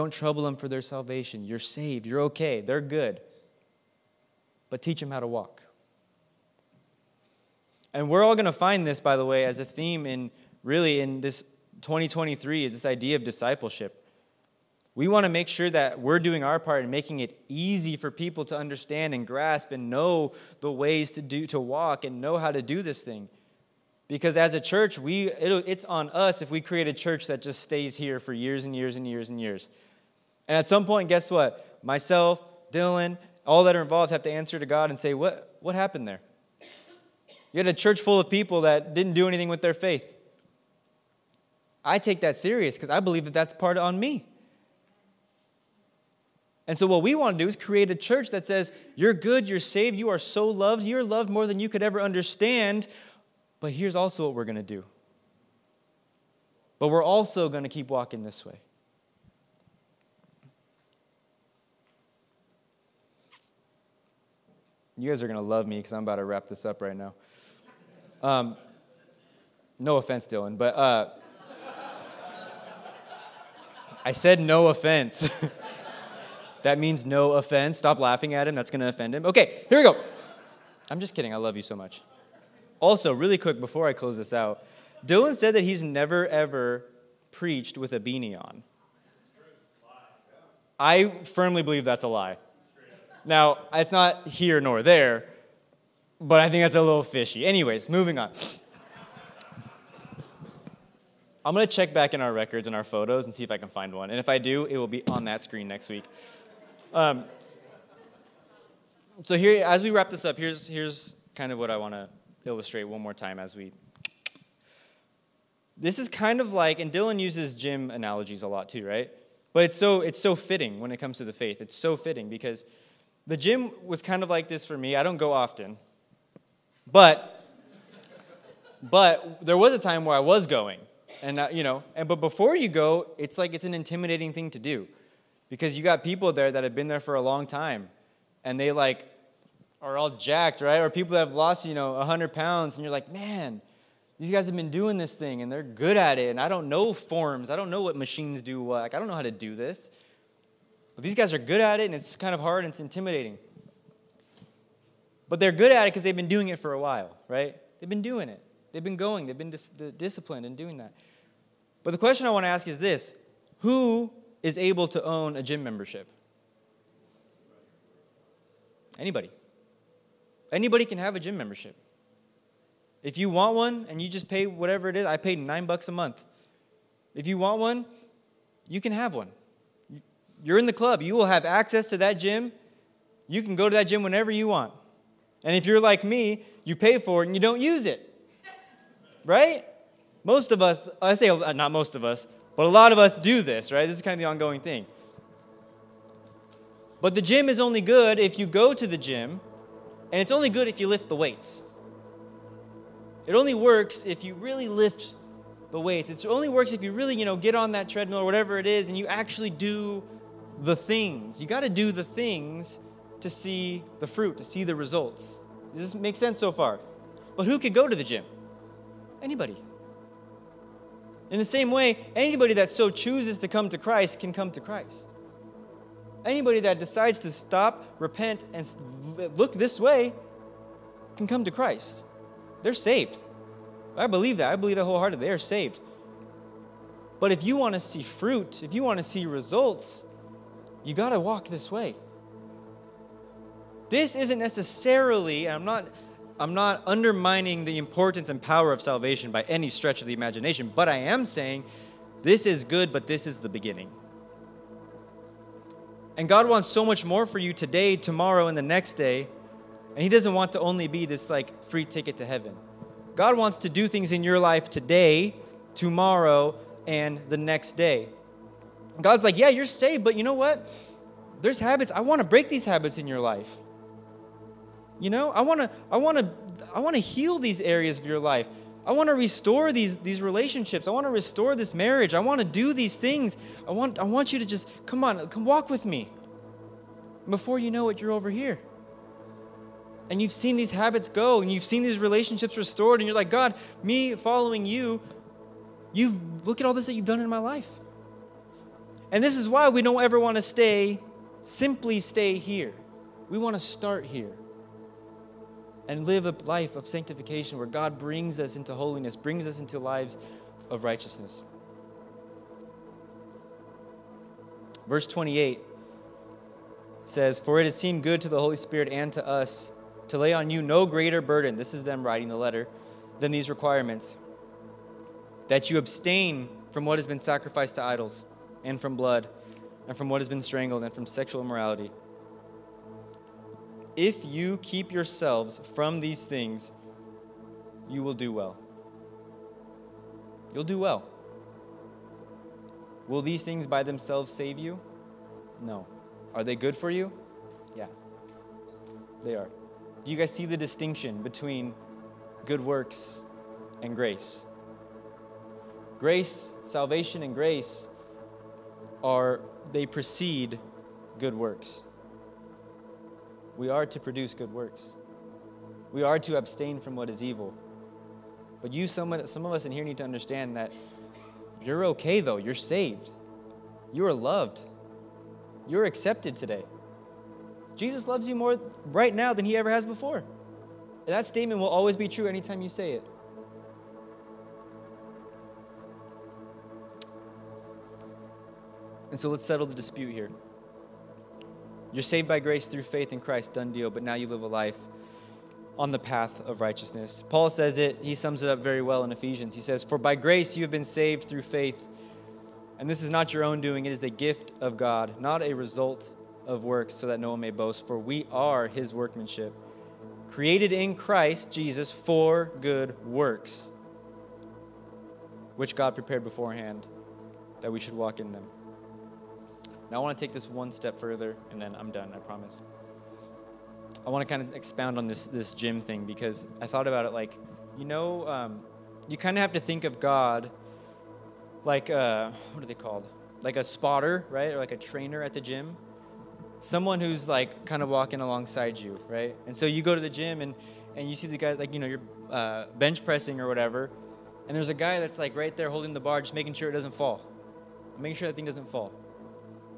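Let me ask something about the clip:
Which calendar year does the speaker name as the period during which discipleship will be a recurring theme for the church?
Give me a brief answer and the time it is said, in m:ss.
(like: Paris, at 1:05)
2023, at 0:11.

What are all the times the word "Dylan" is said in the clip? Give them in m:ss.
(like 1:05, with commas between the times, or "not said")
0:32, 1:10, 1:25, 1:56.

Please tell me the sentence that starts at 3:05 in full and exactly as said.
And if you're like me, you pay for it and you don't use it.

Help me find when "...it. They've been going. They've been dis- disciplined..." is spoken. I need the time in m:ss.
2:38.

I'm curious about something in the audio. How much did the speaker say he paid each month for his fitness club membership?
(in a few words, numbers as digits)
$9.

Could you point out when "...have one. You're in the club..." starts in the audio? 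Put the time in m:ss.
2:58.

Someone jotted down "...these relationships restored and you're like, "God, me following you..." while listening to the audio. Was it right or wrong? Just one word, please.
right.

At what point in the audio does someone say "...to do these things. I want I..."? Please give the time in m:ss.
4:42.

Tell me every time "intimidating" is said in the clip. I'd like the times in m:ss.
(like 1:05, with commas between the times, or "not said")
2:13, 2:32.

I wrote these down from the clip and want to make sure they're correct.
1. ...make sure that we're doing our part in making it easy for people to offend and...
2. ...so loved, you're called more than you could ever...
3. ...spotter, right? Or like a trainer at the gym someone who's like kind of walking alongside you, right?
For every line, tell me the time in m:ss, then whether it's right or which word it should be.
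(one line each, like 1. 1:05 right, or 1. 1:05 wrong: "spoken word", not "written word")
1. 0:15 wrong: "understand", not "offend"
2. 0:50 wrong: "loved", not "called"
3. 7:13 right.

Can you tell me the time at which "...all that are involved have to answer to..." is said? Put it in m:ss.
0:33.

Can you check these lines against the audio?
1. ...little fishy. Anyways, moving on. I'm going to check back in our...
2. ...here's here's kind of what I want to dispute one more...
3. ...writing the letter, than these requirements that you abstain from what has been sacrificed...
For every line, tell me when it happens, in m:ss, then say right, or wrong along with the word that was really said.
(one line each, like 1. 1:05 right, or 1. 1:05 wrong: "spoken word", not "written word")
1. 1:36 right
2. 1:50 wrong: "illustrate", not "dispute"
3. 5:22 right.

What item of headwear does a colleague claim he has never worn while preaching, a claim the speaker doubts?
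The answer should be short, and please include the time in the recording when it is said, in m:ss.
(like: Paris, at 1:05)
beanie, at 1:28.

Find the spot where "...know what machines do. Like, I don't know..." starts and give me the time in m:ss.
2:27.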